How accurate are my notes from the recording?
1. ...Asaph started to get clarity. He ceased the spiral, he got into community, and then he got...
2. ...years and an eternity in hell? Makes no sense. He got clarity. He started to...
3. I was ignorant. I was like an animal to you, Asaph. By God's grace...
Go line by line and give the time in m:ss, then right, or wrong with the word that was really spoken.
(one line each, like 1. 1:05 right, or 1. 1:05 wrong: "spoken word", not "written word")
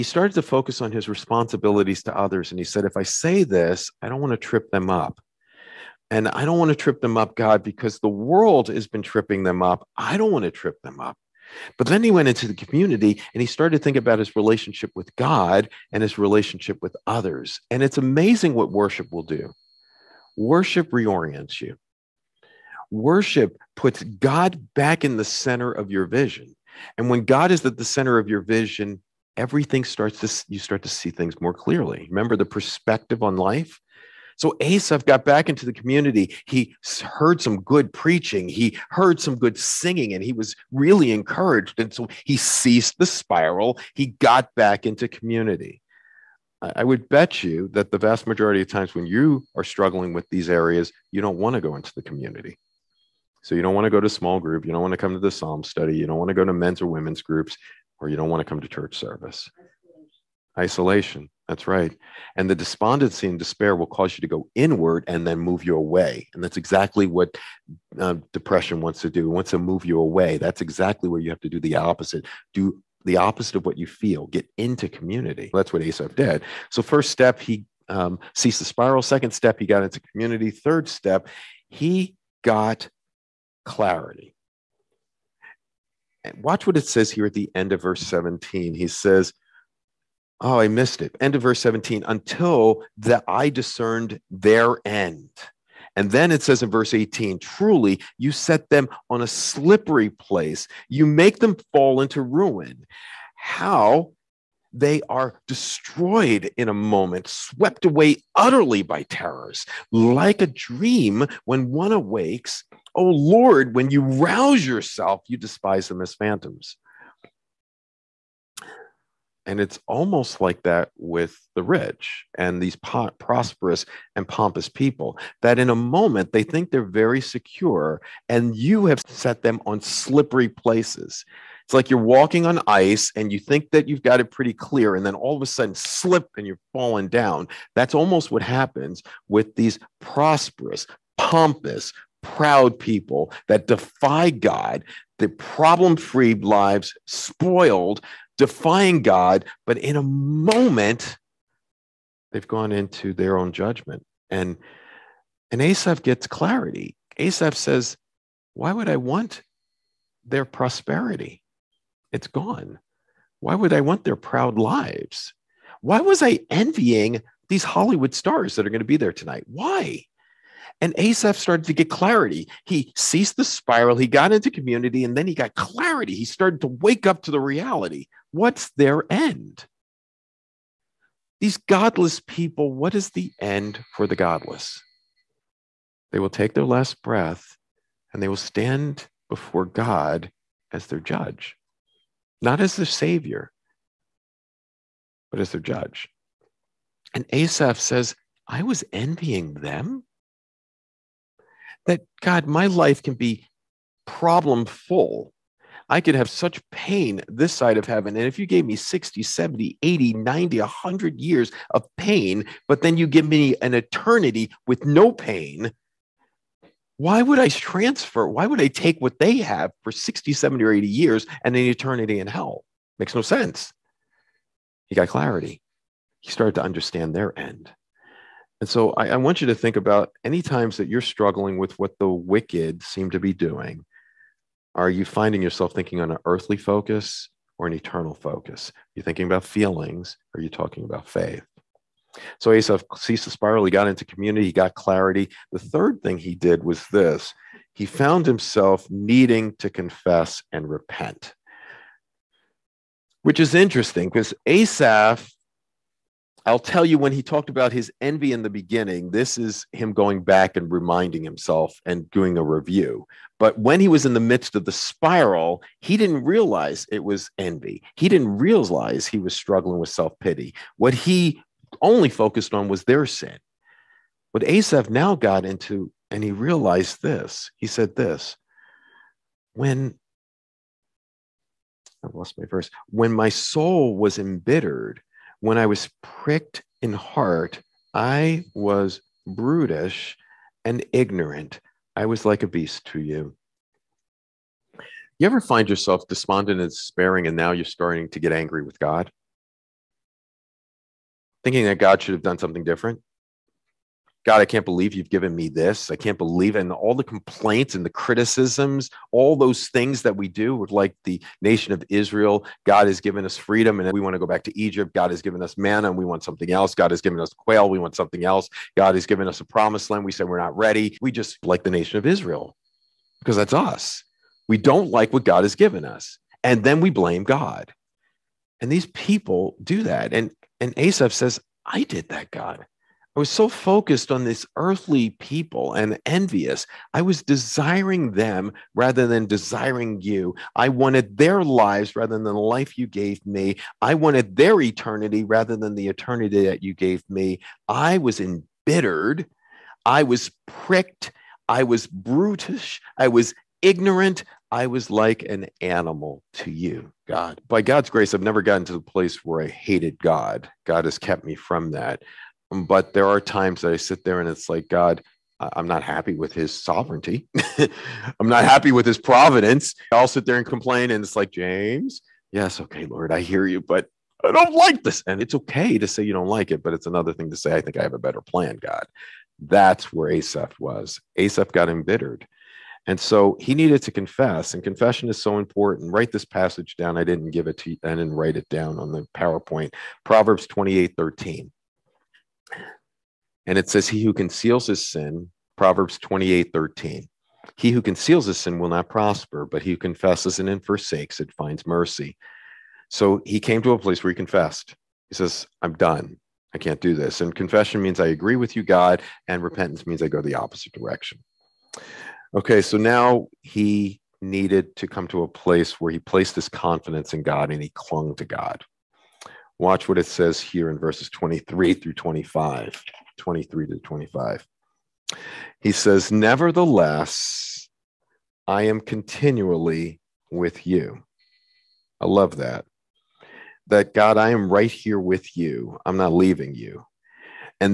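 1. 2:50 right
2. 3:40 right
3. 5:52 wrong: "God", not "Asaph".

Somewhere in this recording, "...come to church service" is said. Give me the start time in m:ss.
0:58.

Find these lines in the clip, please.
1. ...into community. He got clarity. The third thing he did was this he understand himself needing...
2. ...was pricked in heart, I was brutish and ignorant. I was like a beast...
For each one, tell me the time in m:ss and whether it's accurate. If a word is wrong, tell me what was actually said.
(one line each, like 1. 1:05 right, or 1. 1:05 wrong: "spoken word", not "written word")
1. 4:03 wrong: "found", not "understand"
2. 4:45 right.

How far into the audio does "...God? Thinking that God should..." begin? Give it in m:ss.
4:58.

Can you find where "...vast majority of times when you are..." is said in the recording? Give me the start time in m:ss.
0:47.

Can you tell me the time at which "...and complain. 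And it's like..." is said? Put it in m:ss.
6:10.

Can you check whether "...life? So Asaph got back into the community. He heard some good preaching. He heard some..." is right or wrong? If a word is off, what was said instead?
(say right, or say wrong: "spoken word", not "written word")
right.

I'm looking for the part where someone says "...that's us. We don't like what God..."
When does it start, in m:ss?
5:23.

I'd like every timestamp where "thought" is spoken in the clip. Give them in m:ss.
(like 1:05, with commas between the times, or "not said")
not said.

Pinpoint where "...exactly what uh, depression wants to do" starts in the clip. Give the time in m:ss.
1:06.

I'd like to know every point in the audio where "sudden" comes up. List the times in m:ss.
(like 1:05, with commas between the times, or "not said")
2:15.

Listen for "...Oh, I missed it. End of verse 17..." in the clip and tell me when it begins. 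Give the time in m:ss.
1:30.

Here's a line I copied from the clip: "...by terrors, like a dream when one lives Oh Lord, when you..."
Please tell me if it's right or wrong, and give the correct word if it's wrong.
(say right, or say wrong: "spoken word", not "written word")
wrong: "awakes", not "lives".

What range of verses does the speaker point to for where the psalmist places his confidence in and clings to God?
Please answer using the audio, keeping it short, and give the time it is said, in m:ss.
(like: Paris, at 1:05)
23 through 25, at 7:00.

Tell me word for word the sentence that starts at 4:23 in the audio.
But when he was in the midst of the spiral, he didn't realize it was envy.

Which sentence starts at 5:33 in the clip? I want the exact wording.
I was so focused on this earthly people and envious.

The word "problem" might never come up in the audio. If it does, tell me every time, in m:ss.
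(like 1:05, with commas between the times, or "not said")
2:25, 3:24.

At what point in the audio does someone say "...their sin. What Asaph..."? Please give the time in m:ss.
4:32.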